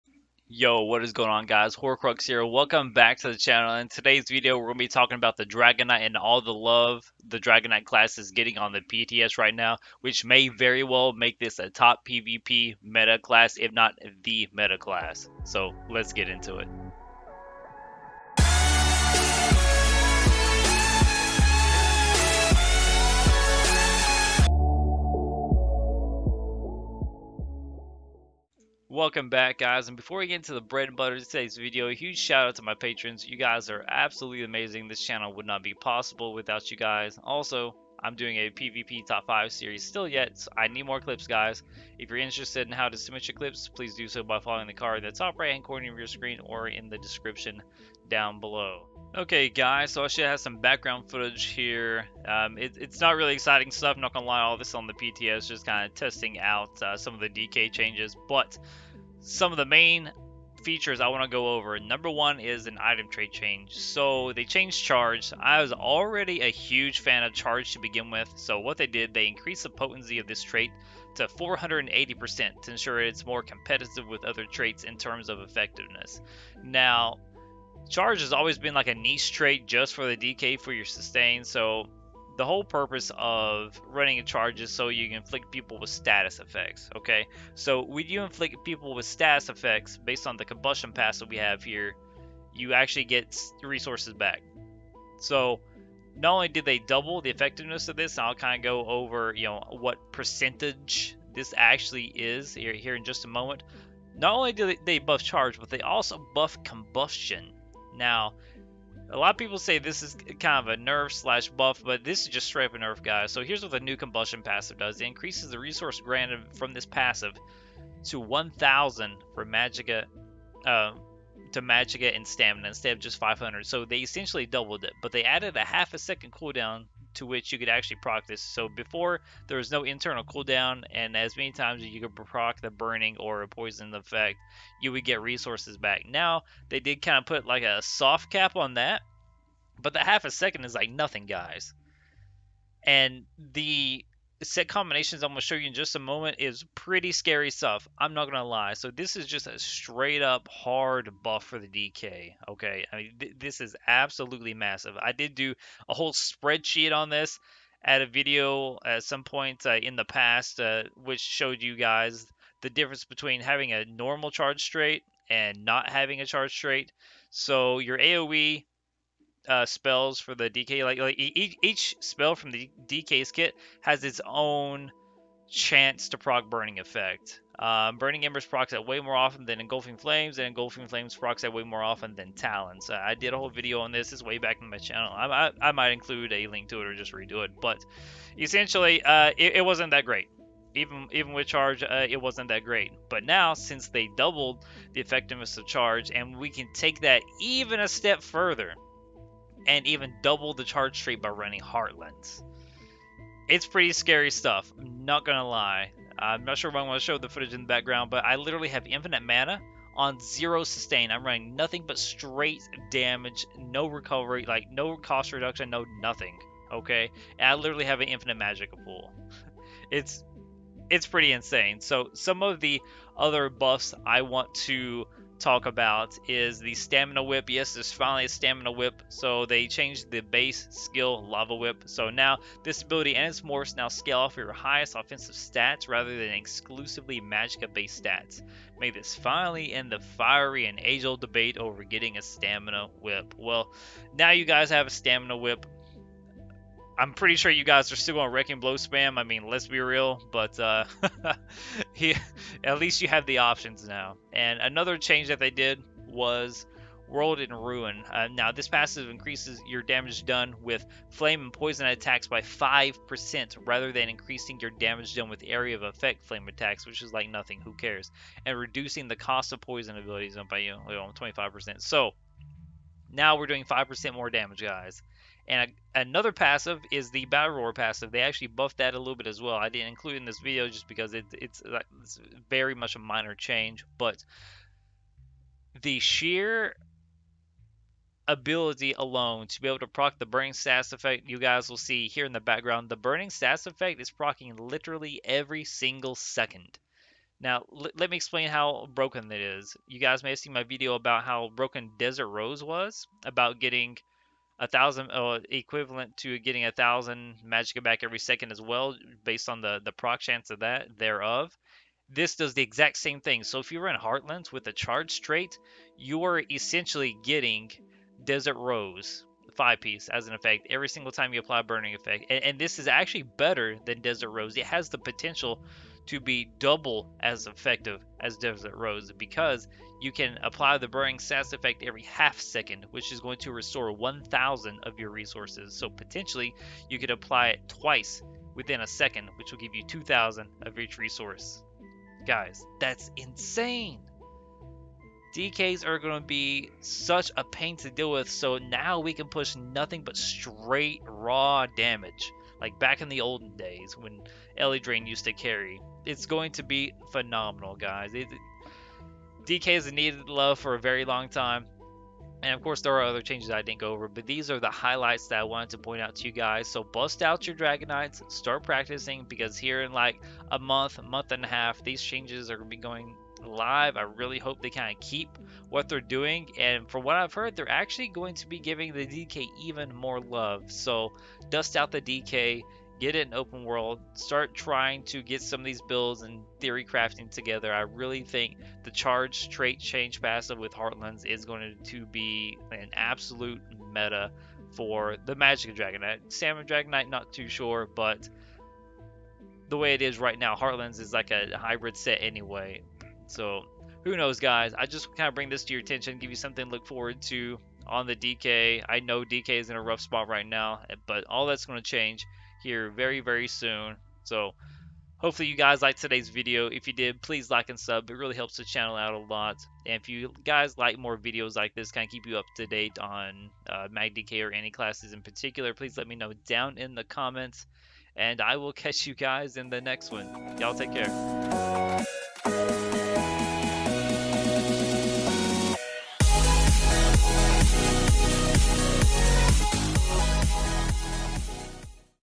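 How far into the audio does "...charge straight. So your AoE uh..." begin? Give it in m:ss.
2:46.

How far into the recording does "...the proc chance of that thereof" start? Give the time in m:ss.
5:09.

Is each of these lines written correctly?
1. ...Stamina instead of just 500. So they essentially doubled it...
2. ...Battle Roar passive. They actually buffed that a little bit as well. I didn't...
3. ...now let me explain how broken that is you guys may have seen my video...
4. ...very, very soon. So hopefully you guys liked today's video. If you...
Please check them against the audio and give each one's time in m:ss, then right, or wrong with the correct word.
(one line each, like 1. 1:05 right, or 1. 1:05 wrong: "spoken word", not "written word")
1. 2:02 right
2. 4:37 right
3. 4:57 right
4. 6:52 right.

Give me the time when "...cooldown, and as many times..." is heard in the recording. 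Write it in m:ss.
2:10.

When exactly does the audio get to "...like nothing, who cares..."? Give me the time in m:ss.
4:27.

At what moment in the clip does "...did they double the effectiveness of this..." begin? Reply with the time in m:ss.
1:36.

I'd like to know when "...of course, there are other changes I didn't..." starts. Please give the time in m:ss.
6:02.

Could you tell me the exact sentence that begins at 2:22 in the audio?
And the set combinations I'm going to show you in just a moment is pretty scary stuff.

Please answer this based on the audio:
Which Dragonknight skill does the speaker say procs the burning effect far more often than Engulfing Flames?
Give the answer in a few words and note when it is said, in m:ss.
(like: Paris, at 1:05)
Burning Embers, at 2:57.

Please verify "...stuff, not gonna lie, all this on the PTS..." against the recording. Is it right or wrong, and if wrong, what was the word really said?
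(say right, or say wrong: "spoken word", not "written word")
right.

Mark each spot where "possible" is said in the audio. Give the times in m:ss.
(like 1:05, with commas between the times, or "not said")
0:35.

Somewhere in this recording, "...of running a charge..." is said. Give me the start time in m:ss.
1:23.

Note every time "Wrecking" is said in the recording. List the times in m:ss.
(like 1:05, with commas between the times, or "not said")
4:08.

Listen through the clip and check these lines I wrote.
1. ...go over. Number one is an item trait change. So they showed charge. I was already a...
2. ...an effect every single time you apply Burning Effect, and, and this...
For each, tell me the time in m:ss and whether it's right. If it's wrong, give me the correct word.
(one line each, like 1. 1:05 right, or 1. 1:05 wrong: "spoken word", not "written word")
1. 1:01 wrong: "changed", not "showed"
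2. 5:20 right.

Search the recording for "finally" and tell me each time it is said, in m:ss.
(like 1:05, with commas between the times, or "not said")
3:47, 3:59.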